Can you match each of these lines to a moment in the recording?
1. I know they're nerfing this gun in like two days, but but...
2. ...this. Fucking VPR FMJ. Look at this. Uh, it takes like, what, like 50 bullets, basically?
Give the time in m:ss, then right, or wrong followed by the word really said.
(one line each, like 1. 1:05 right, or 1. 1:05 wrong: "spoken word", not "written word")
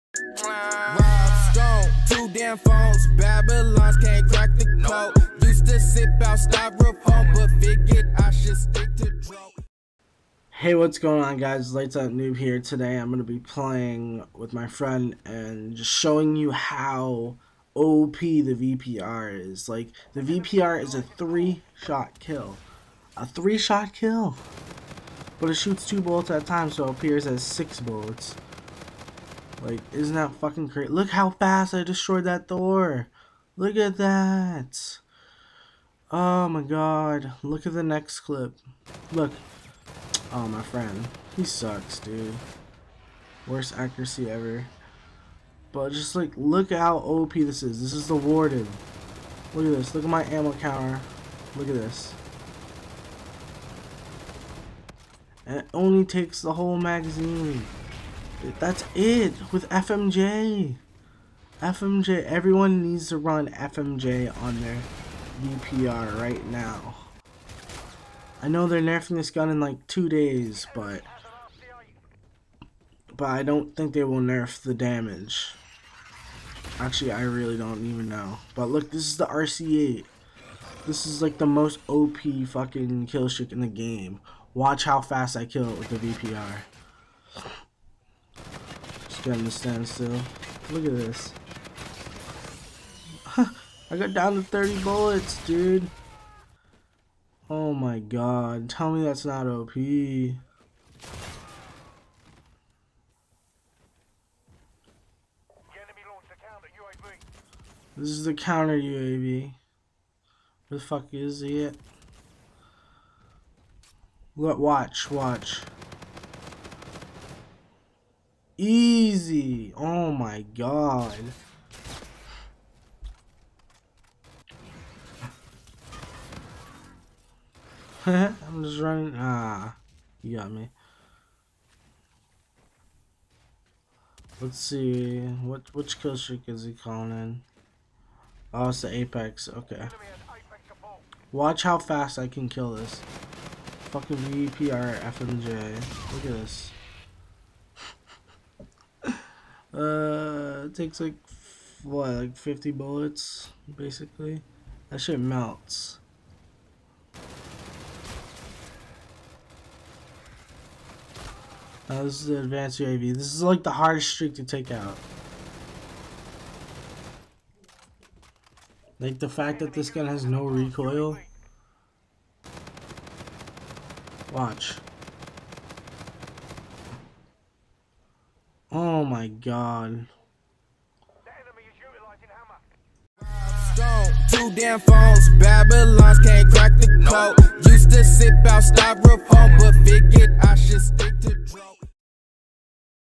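1. 1:08 right
2. 2:22 right.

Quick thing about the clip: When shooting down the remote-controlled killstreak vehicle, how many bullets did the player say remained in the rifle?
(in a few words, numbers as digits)
30.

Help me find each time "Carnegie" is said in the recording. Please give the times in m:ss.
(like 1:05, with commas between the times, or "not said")
not said.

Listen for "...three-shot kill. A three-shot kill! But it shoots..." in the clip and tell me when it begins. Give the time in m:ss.
0:21.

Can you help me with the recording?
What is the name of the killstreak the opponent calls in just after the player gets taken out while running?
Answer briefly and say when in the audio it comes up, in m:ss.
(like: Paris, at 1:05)
Apex, at 2:18.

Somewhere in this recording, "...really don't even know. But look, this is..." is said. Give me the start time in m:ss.
1:17.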